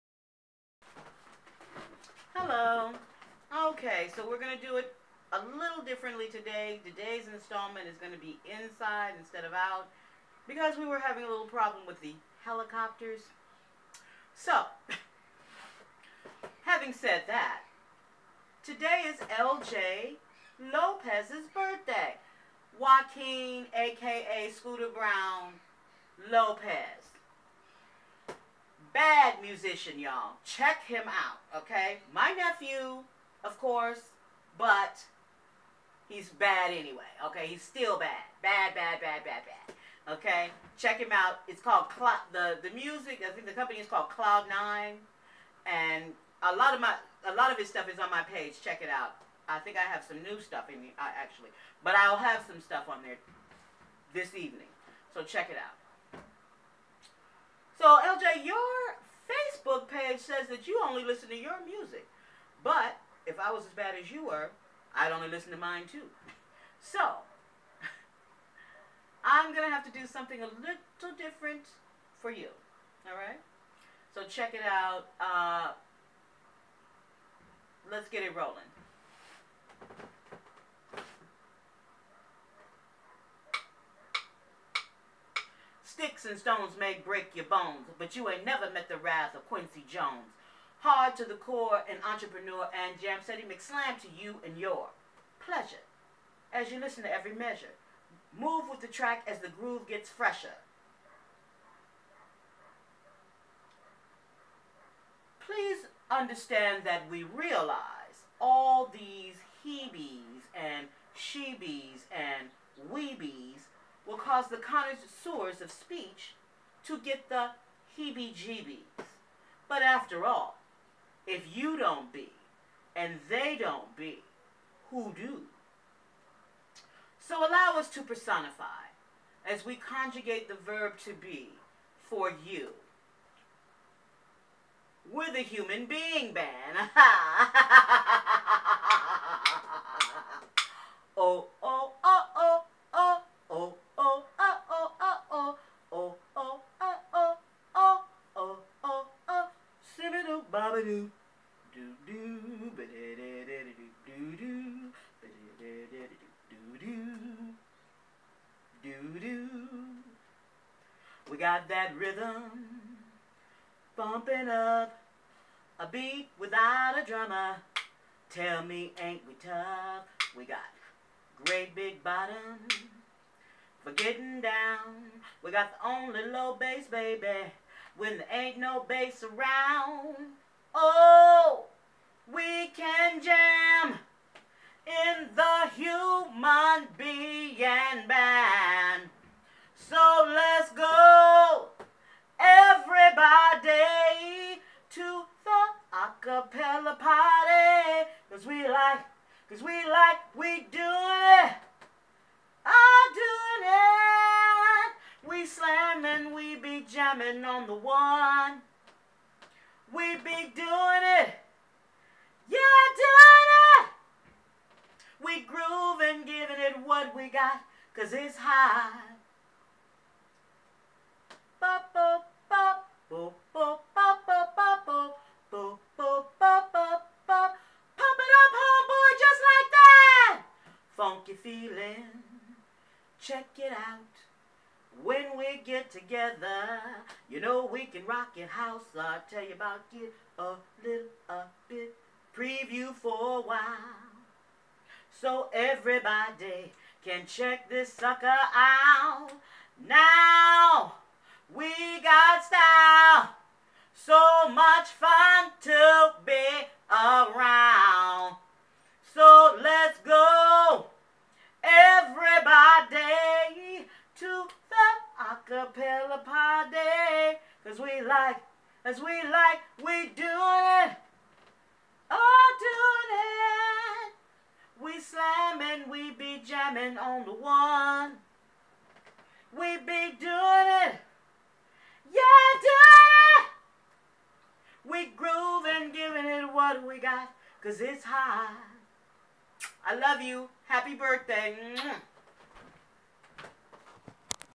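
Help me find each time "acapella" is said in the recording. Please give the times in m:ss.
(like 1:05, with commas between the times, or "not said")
3:15, 4:25.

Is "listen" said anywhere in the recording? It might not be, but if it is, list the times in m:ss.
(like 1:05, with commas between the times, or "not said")
1:01, 1:05, 1:36.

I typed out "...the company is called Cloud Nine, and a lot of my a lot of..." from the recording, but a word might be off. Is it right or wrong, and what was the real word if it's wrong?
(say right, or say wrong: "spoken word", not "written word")
right.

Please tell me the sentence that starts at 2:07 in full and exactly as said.
So allow us to personify as we conjugate the verb to be for you.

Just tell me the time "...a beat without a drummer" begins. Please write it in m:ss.
2:45.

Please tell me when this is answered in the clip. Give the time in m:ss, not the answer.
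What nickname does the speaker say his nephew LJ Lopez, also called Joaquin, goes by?
0:24.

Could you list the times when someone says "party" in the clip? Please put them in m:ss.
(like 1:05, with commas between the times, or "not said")
3:16, 4:26.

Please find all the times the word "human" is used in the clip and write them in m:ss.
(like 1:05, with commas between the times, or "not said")
2:15, 3:05.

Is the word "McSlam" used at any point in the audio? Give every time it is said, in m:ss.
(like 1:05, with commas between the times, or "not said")
1:33.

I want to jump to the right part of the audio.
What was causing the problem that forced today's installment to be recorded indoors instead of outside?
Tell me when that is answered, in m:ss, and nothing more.
0:12.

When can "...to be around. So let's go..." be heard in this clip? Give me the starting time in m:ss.
4:15.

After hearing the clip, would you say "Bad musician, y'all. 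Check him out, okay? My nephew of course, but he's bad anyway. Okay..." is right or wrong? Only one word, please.
right.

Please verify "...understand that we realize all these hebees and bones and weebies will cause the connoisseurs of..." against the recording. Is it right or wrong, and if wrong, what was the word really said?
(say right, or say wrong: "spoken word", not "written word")
wrong: "shebees", not "bones".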